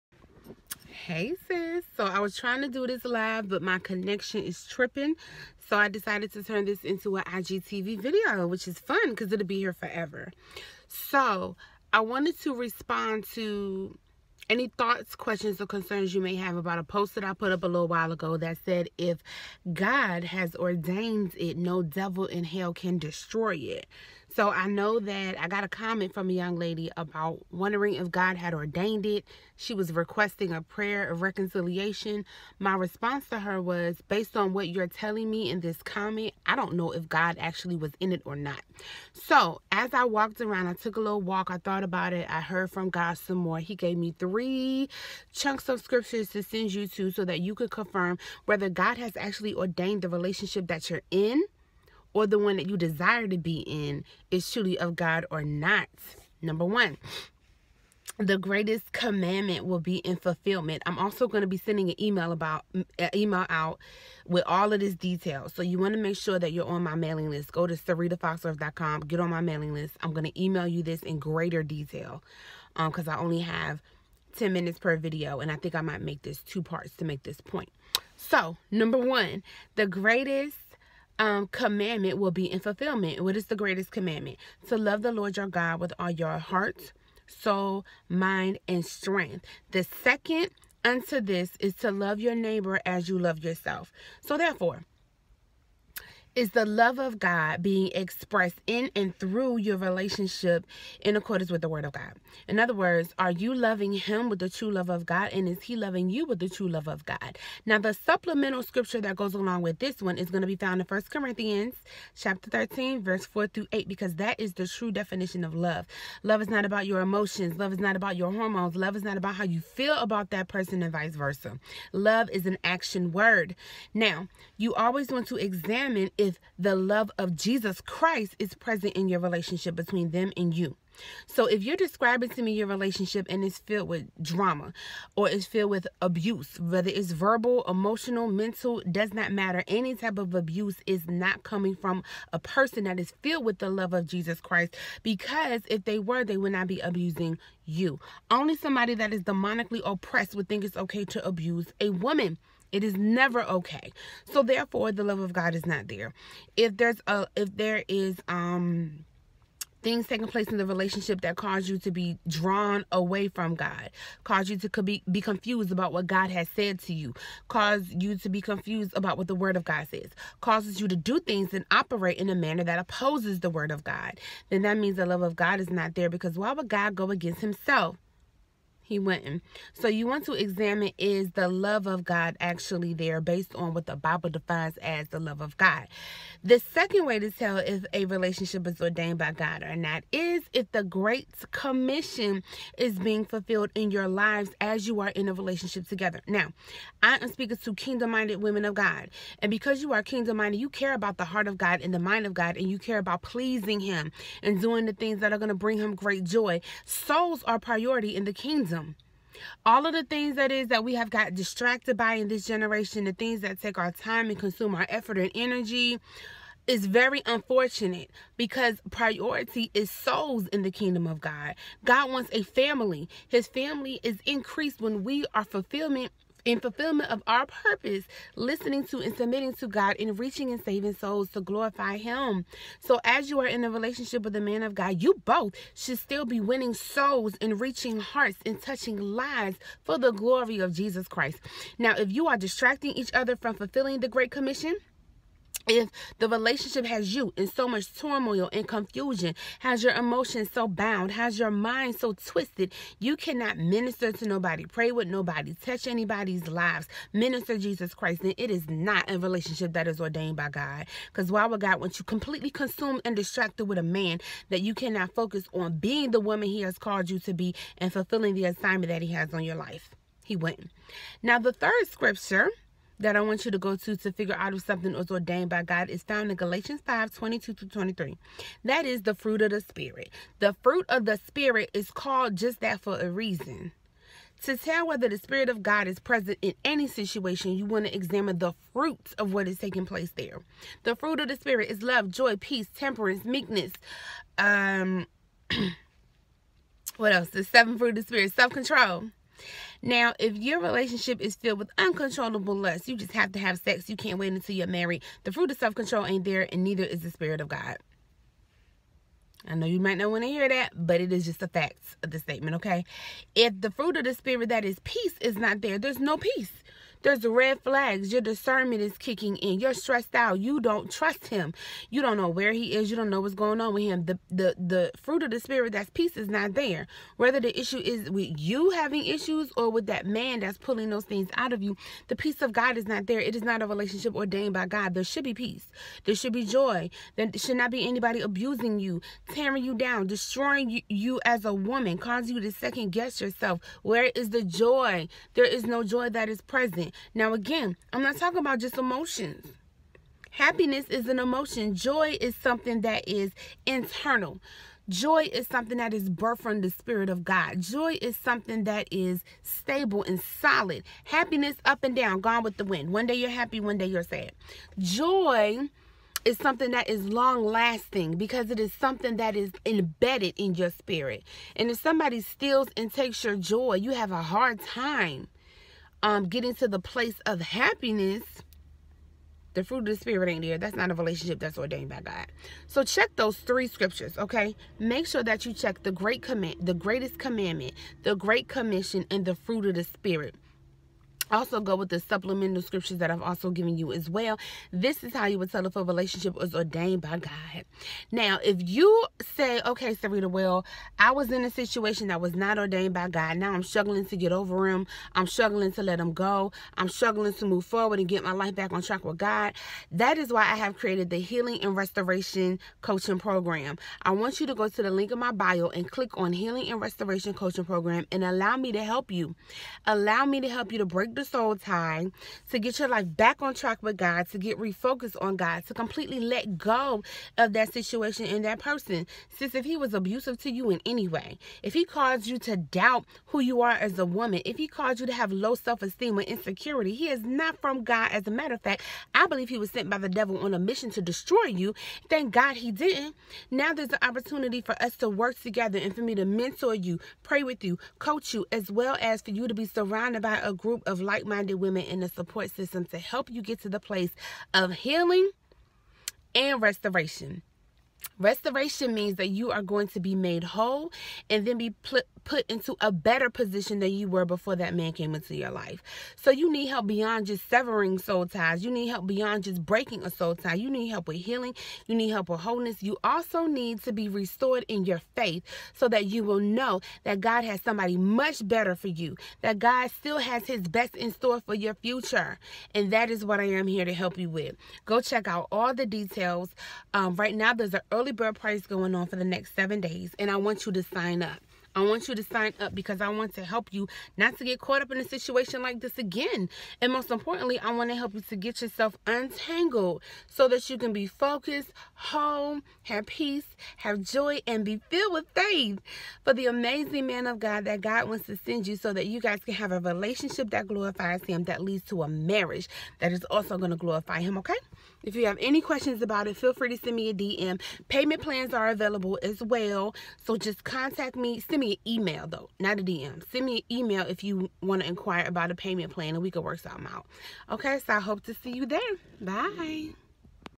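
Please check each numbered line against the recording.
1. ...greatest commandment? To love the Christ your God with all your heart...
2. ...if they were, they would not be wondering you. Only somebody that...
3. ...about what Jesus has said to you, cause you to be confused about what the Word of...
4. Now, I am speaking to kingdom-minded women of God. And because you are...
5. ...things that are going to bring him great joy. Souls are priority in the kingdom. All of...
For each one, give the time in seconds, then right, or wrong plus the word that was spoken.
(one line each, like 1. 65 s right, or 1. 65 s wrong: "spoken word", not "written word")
1. 83 s wrong: "Lord", not "Christ"
2. 145 s wrong: "abusing", not "wondering"
3. 165 s wrong: "God", not "Jesus"
4. 196 s right
5. 204 s right.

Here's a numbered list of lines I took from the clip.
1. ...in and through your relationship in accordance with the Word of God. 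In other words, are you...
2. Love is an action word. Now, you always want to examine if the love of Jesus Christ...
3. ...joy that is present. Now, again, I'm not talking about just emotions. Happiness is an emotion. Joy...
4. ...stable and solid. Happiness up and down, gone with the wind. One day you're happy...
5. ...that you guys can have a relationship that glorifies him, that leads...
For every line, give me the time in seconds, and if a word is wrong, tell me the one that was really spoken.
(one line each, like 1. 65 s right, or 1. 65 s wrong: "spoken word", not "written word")
1. 98 s right
2. 121 s right
3. 345 s right
4. 359 s right
5. 508 s right.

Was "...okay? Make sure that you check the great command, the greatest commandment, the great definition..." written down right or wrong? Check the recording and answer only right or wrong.
wrong.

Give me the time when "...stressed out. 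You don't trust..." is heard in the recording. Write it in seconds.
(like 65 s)
319 s.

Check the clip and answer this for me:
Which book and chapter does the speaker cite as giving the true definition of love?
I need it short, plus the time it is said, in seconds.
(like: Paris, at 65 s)
First Corinthians 13, at 110 s.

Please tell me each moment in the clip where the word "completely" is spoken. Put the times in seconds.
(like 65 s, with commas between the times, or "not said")
262 s, 425 s.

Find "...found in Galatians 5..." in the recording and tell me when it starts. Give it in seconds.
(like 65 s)
276 s.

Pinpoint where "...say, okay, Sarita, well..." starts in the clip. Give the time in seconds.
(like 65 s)
399 s.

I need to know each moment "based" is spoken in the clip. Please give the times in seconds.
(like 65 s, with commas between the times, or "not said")
34 s, 183 s.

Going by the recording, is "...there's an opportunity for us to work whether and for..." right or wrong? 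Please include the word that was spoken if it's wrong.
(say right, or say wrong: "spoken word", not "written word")
wrong: "together", not "whether".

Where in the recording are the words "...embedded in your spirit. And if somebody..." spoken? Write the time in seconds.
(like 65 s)
369 s.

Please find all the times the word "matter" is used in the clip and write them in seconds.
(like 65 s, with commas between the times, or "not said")
139 s, 438 s.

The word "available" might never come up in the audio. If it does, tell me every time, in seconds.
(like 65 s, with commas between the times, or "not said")
518 s.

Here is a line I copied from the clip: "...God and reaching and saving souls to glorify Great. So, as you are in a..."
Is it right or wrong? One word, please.
wrong.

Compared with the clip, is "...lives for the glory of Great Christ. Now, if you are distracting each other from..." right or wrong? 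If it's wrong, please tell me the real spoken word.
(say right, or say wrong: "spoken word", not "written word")
wrong: "Jesus", not "Great".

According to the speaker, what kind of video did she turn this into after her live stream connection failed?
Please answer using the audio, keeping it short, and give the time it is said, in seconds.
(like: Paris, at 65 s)
IGTV video, at 7 s.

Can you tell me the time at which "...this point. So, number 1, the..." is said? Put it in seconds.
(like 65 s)
77 s.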